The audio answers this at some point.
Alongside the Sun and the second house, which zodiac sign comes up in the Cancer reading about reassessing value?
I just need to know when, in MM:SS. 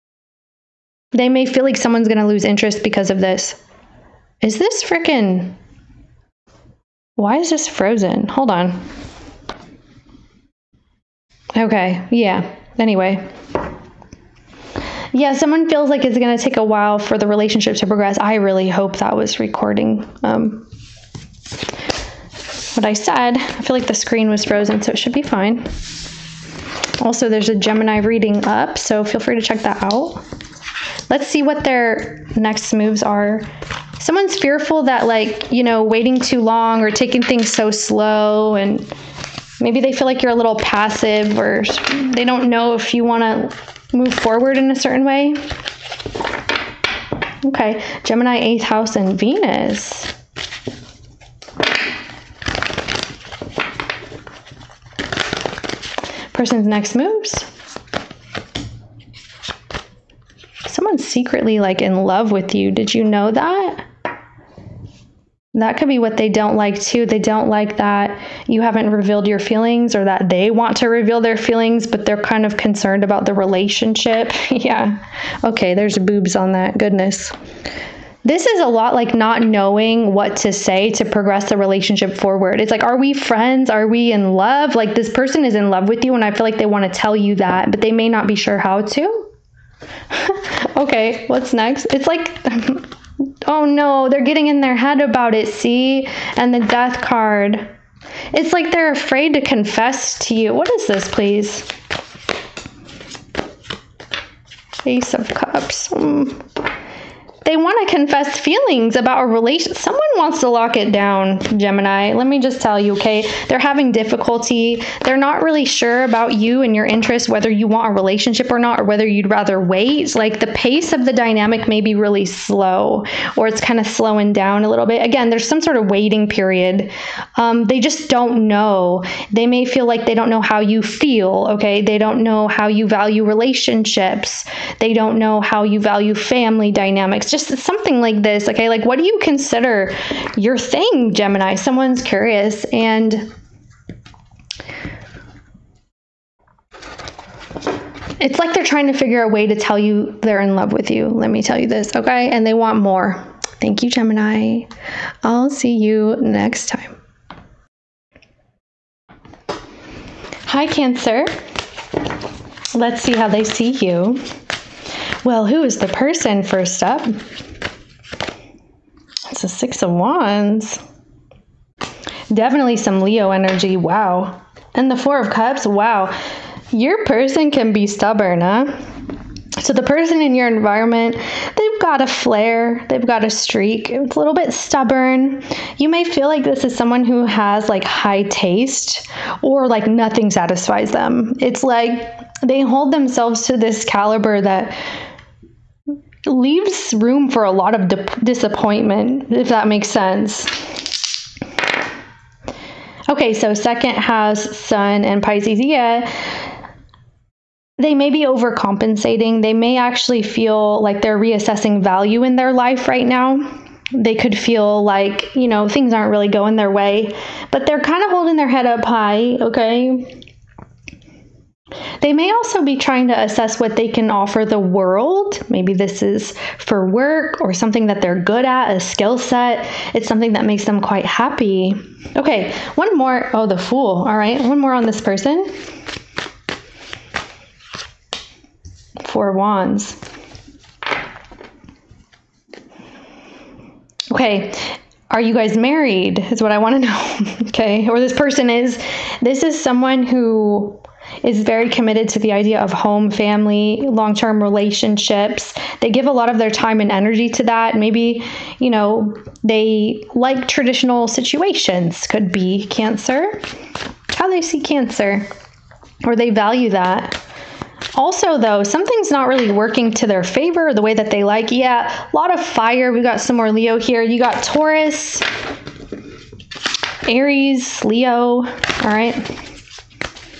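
03:25.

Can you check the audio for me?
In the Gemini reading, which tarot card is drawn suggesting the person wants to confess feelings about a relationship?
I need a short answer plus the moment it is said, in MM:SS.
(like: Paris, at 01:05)
Ace of Cups, at 01:44.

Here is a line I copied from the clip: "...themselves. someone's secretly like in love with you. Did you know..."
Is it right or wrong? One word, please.
wrong.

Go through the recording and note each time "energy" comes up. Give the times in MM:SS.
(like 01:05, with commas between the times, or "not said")
02:53, 04:16.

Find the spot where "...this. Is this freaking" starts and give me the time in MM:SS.
00:03.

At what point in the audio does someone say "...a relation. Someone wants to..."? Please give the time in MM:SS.
01:49.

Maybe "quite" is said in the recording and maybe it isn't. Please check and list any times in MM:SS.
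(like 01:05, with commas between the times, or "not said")
03:50.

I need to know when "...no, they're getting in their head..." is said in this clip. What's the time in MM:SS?
01:33.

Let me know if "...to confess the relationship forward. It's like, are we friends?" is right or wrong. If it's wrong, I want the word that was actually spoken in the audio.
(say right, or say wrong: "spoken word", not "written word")
wrong: "progress", not "confess".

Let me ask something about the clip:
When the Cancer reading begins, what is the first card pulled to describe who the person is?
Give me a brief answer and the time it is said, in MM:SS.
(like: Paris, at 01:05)
Six of Wands, at 02:49.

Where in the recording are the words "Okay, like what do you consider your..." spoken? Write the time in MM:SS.
02:18.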